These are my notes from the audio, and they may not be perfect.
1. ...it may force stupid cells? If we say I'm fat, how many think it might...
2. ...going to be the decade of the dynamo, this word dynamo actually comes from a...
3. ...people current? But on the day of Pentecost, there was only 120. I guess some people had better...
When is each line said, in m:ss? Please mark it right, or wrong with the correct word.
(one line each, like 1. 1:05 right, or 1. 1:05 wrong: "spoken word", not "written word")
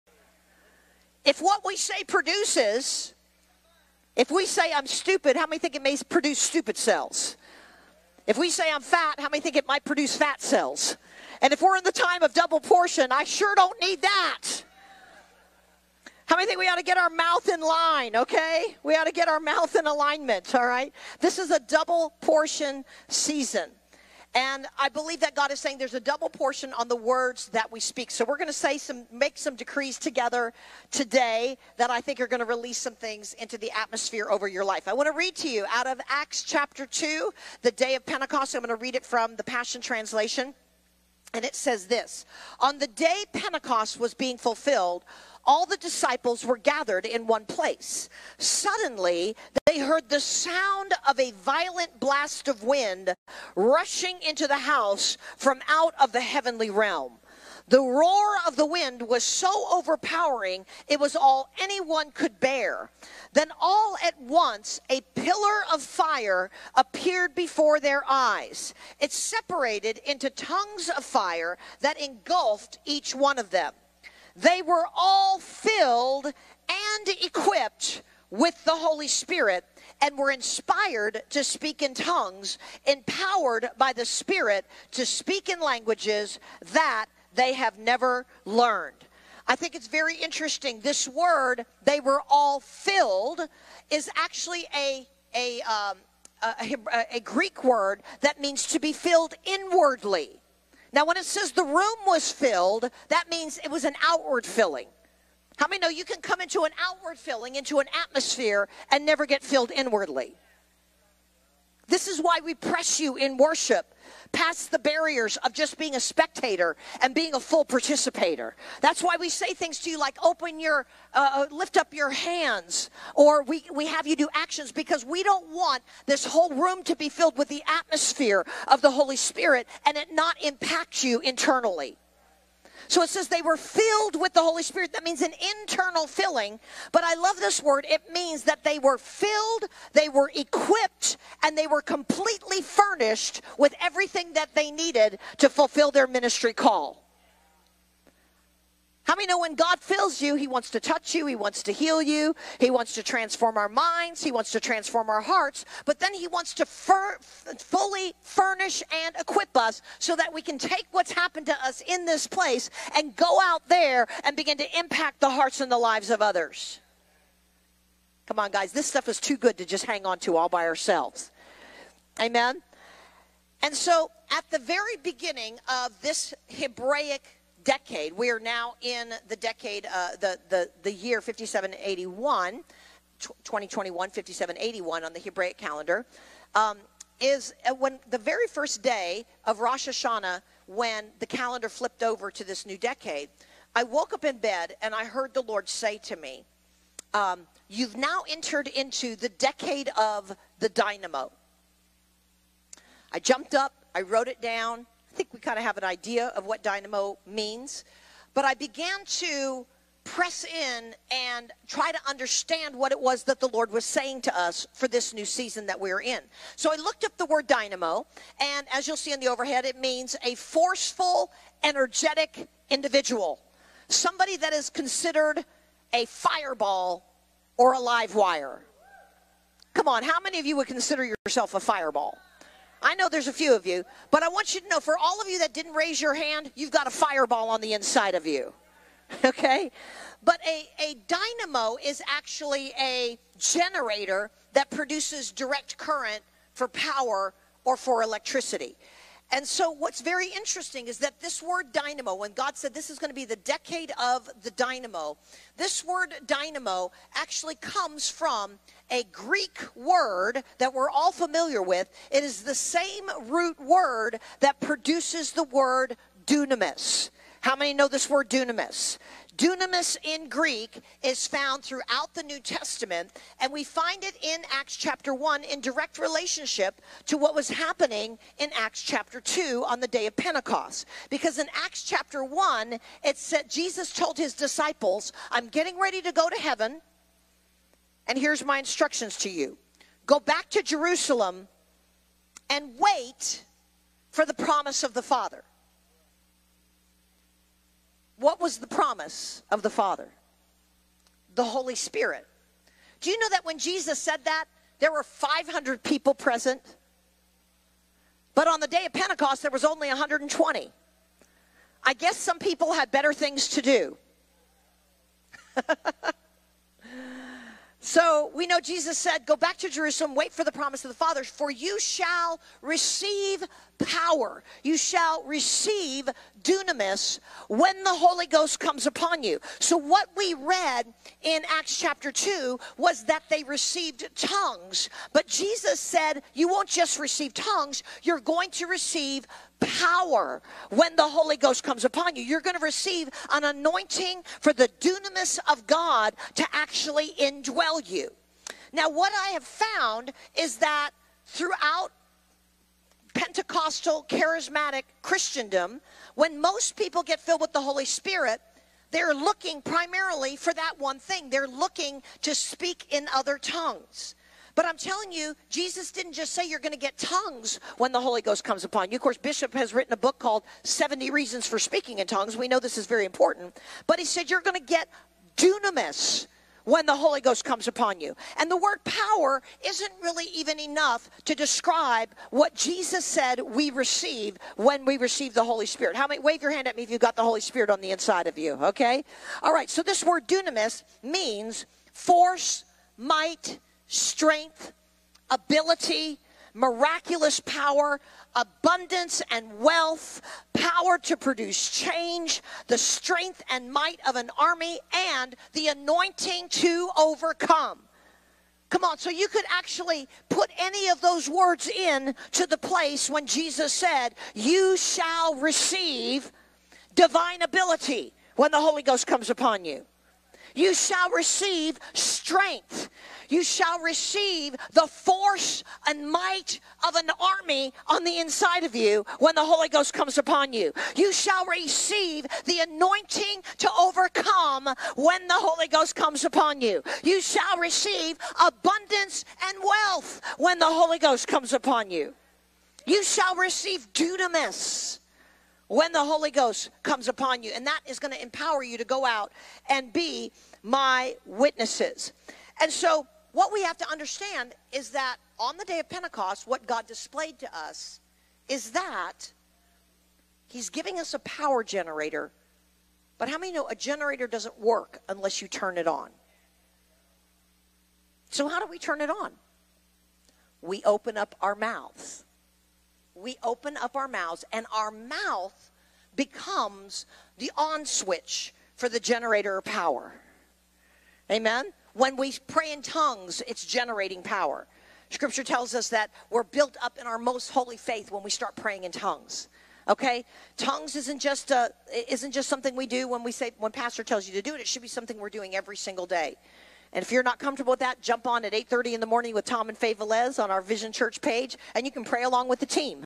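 1. 0:05 wrong: "produce", not "force"
2. 4:12 right
3. 5:05 wrong: "present", not "current".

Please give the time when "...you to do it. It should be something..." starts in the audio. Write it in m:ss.
8:14.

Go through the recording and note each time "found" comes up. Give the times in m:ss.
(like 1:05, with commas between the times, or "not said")
4:31, 5:49.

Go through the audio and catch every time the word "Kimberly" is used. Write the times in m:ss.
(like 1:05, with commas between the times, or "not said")
not said.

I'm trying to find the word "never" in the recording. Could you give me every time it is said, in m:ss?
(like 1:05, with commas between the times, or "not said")
1:27, 1:49.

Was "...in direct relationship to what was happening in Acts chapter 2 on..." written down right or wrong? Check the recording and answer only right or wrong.
right.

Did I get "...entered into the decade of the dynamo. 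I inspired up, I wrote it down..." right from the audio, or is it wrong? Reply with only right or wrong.
wrong.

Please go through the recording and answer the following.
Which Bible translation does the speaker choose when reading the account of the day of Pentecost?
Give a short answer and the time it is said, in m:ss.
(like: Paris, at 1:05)
Passion Translation, at 0:39.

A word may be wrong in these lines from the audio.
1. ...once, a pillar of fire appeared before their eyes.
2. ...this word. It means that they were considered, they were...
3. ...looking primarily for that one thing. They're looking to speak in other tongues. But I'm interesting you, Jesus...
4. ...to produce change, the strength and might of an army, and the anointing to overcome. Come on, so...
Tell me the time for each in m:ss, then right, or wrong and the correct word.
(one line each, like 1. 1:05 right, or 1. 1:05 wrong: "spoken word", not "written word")
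1. 1:04 right
2. 2:17 wrong: "filled", not "considered"
3. 5:59 wrong: "telling", not "interesting"
4. 6:41 right.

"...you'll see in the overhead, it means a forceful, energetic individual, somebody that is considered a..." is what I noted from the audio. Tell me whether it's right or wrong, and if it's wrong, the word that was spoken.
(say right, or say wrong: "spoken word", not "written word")
right.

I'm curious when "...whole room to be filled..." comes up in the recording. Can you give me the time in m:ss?
2:06.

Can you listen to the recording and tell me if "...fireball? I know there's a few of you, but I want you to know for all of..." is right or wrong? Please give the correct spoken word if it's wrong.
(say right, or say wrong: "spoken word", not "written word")
right.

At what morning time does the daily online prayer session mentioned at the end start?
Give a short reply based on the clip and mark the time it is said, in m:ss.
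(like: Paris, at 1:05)
8:30, at 8:18.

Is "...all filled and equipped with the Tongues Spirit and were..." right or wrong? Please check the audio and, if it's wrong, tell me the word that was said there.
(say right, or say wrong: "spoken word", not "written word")
wrong: "Holy", not "Tongues".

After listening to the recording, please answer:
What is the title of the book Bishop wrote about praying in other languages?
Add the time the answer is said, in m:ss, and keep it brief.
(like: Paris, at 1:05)
70 Reasons for Speaking in Tongues, at 6:10.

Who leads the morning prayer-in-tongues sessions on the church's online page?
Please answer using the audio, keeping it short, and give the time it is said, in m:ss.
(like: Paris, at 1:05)
Tom and Faye Velez, at 8:19.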